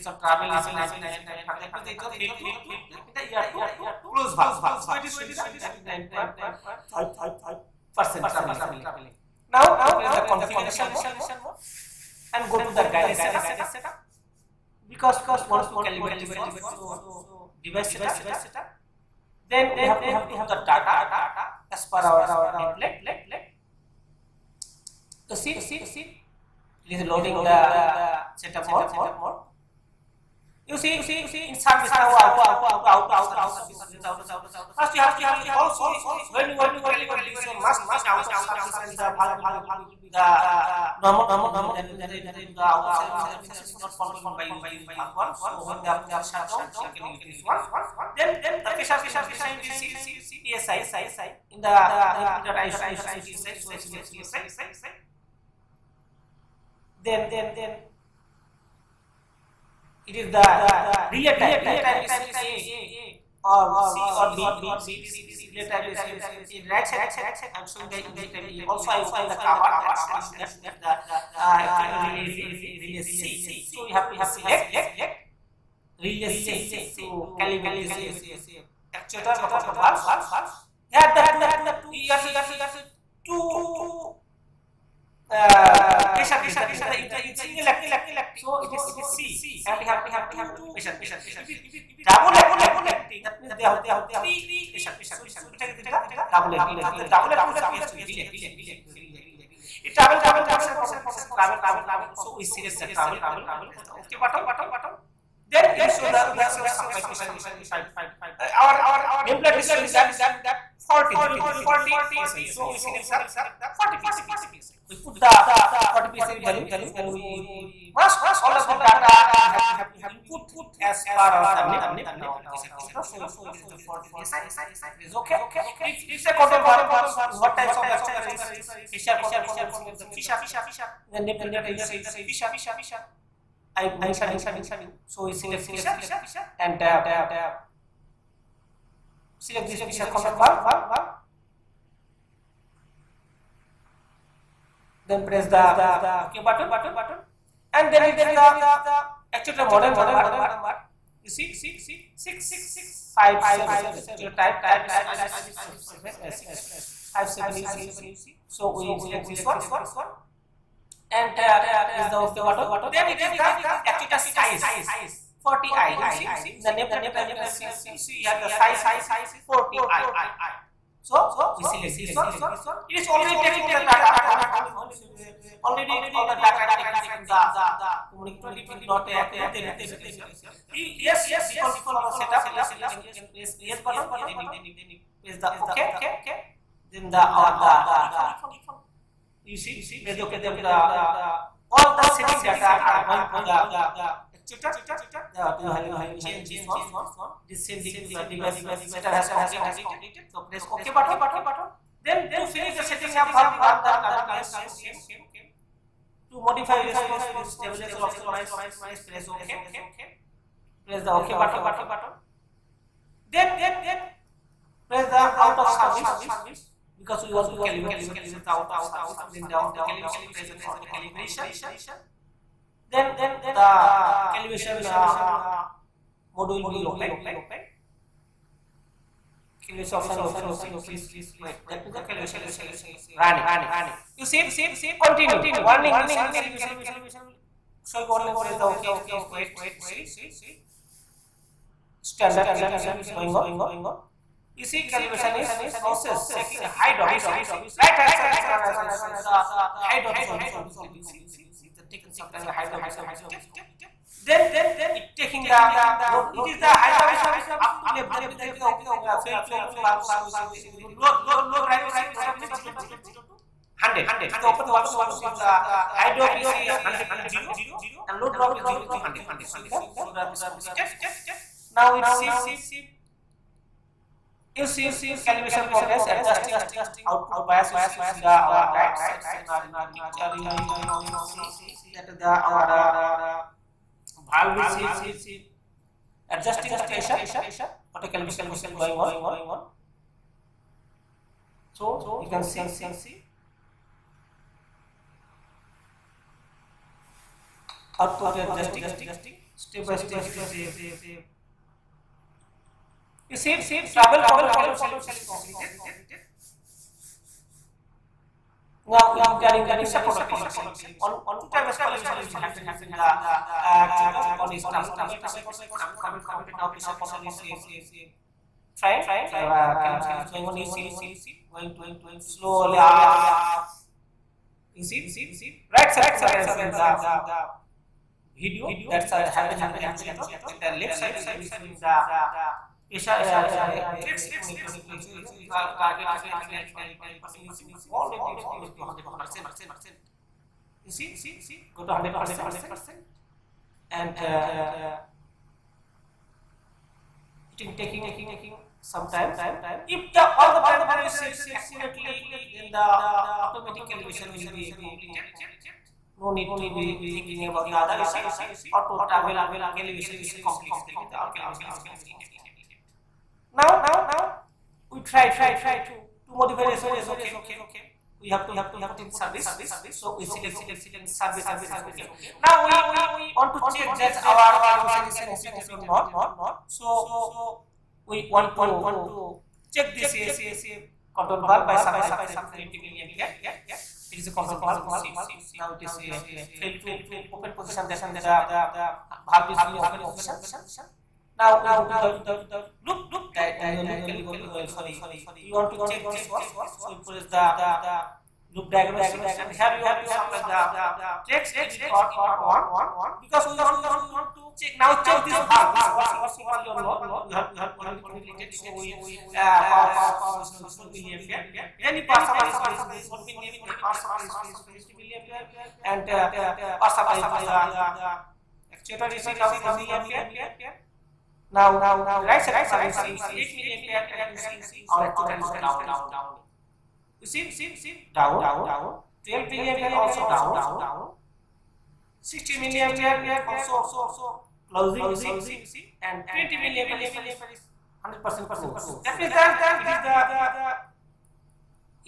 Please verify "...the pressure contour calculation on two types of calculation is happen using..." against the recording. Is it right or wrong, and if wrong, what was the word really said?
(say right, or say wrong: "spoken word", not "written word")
right.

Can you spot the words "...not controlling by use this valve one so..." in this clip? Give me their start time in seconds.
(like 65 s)
43 s.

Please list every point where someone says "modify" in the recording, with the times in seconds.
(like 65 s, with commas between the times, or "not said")
206 s, 366 s.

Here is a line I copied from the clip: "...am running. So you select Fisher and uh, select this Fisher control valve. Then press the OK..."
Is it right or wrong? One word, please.
wrong.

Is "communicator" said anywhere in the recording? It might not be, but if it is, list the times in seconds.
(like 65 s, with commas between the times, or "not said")
178 s.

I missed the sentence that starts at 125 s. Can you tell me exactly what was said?
The Fisher control one is what types of actuator is Fisher control.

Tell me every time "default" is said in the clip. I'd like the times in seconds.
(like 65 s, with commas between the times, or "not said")
181 s, 188 s.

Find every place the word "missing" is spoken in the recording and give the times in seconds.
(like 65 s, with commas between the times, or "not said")
not said.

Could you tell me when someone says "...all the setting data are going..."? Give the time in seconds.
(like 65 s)
191 s.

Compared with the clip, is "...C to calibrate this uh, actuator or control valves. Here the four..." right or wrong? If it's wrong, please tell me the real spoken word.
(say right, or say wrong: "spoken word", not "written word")
wrong: "two", not "four".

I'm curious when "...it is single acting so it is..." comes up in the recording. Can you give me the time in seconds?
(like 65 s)
86 s.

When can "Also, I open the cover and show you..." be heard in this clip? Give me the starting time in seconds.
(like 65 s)
68 s.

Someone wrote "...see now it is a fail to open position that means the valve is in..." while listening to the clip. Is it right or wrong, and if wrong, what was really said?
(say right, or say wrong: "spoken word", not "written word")
right.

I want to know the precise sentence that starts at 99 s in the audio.
It travel control, pressure control, it is travel control.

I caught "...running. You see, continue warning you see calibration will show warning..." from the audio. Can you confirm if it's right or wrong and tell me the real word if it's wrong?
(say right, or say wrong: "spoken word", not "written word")
right.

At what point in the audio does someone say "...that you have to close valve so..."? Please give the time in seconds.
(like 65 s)
3 s.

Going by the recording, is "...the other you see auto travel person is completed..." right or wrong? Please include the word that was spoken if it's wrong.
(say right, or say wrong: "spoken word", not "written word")
wrong: "calibration", not "person".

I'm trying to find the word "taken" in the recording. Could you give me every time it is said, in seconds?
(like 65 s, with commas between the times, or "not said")
176 s.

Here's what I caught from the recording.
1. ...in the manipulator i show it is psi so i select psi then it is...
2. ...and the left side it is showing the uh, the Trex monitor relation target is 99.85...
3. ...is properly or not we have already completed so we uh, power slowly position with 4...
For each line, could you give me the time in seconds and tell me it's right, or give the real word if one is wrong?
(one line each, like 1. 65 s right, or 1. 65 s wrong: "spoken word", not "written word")
1. 51 s right
2. 330 s right
3. 406 s wrong: "supply", not "slowly".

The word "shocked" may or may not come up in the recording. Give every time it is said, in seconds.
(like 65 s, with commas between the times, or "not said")
not said.